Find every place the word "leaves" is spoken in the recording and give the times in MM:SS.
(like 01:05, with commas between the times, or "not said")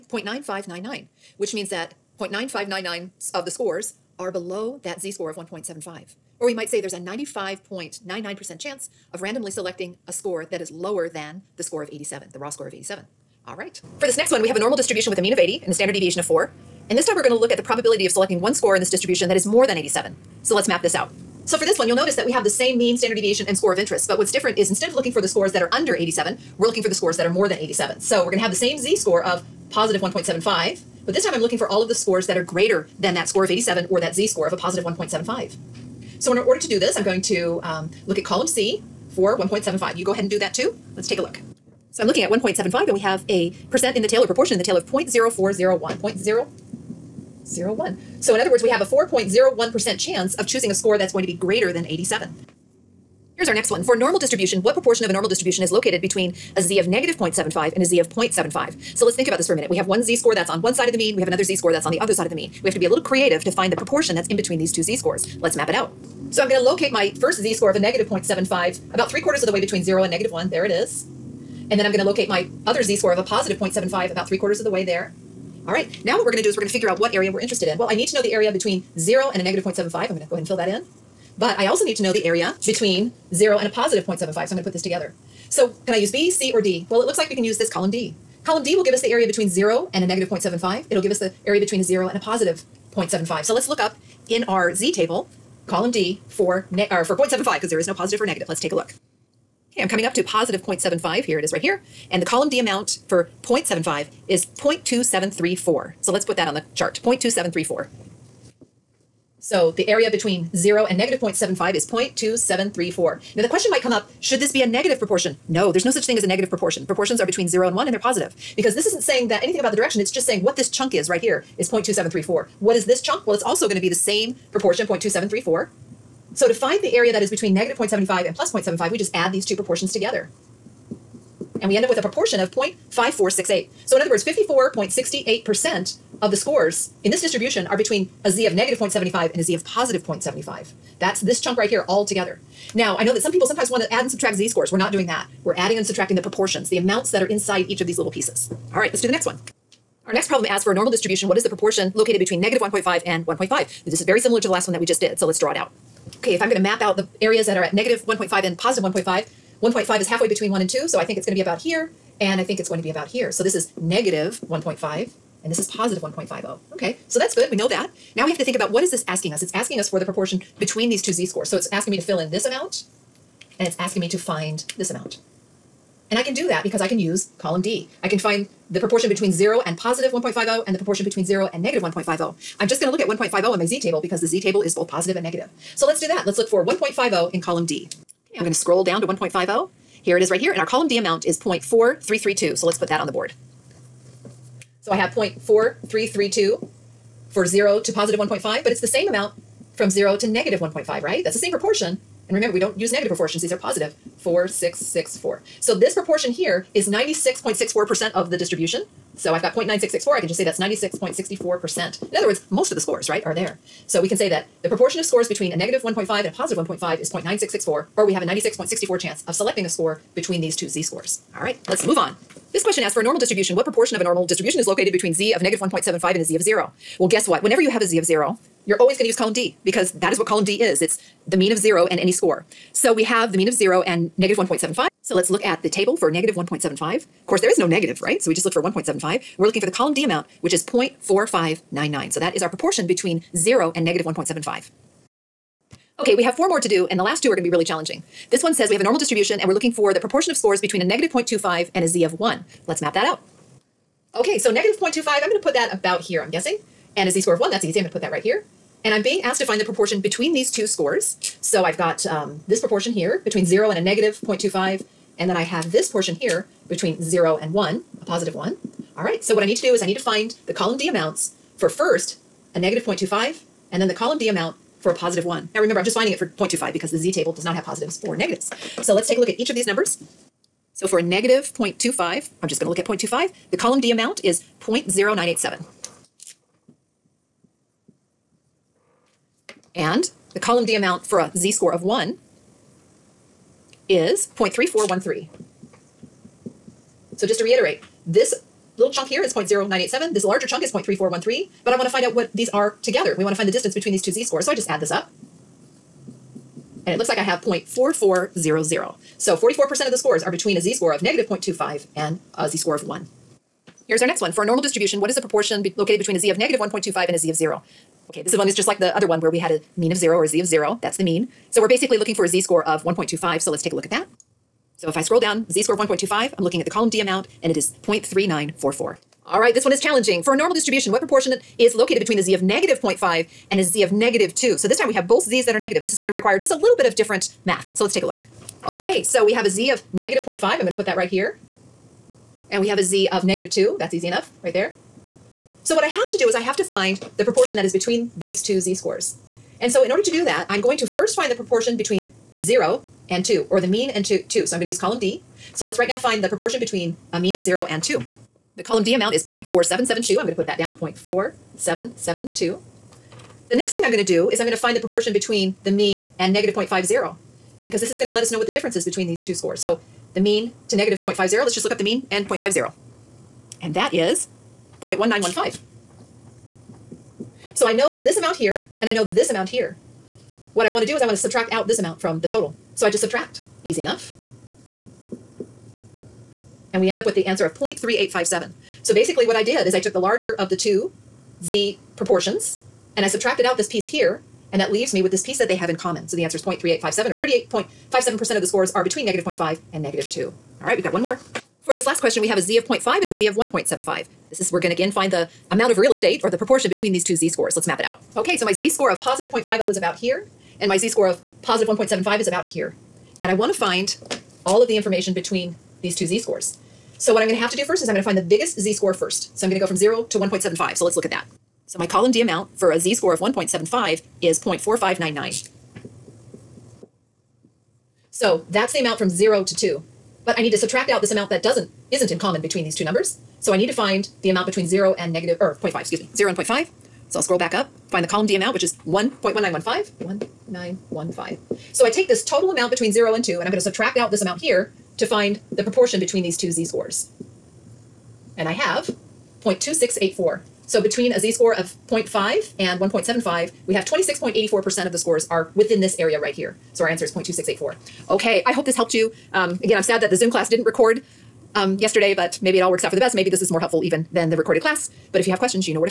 06:34.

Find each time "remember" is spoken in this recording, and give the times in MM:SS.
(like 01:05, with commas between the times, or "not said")
03:22, 04:35.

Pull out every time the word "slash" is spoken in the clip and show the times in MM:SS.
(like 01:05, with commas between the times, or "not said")
not said.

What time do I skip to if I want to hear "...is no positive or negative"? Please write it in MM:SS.
01:37.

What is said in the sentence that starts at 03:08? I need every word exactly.
am going to scroll down to 1.50 here it is right here, and our column D amount is 0.4332.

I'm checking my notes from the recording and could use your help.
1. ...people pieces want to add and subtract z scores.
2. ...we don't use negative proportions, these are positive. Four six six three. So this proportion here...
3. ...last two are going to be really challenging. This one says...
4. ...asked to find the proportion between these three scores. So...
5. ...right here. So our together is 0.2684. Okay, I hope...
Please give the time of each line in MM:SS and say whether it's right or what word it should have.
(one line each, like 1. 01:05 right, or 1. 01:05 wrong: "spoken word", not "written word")
1. 02:23 wrong: "sometimes", not "pieces"
2. 03:22 wrong: "four", not "three"
3. 04:07 right
4. 04:19 wrong: "two", not "three"
5. 07:36 wrong: "answer", not "together".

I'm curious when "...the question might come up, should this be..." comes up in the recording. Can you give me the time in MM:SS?
01:53.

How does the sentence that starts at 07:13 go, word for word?
So I need to find the amount between zero and negative, or 0.5, excuse me, zero and 0.5.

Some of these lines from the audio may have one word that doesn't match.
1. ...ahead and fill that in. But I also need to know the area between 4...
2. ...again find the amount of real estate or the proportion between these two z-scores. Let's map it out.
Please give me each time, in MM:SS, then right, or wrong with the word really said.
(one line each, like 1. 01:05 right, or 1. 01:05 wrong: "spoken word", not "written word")
1. 01:20 wrong: "0", not "4"
2. 06:44 right.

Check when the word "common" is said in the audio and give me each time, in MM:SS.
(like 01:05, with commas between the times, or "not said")
06:35, 07:12.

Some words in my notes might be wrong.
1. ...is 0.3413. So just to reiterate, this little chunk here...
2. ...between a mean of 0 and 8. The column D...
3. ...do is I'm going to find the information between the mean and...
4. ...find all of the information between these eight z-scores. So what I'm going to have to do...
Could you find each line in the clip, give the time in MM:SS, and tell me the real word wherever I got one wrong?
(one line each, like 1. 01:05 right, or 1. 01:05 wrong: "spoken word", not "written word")
1. 04:53 right
2. 05:56 wrong: "2", not "8"
3. 06:04 wrong: "proportion", not "information"
4. 06:53 wrong: "two", not "eight".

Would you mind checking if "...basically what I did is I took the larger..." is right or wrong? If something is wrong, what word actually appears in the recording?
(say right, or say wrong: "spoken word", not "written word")
right.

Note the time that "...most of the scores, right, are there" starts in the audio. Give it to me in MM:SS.
03:32.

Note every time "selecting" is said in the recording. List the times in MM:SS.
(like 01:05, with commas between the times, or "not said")
00:09, 00:18, 03:39.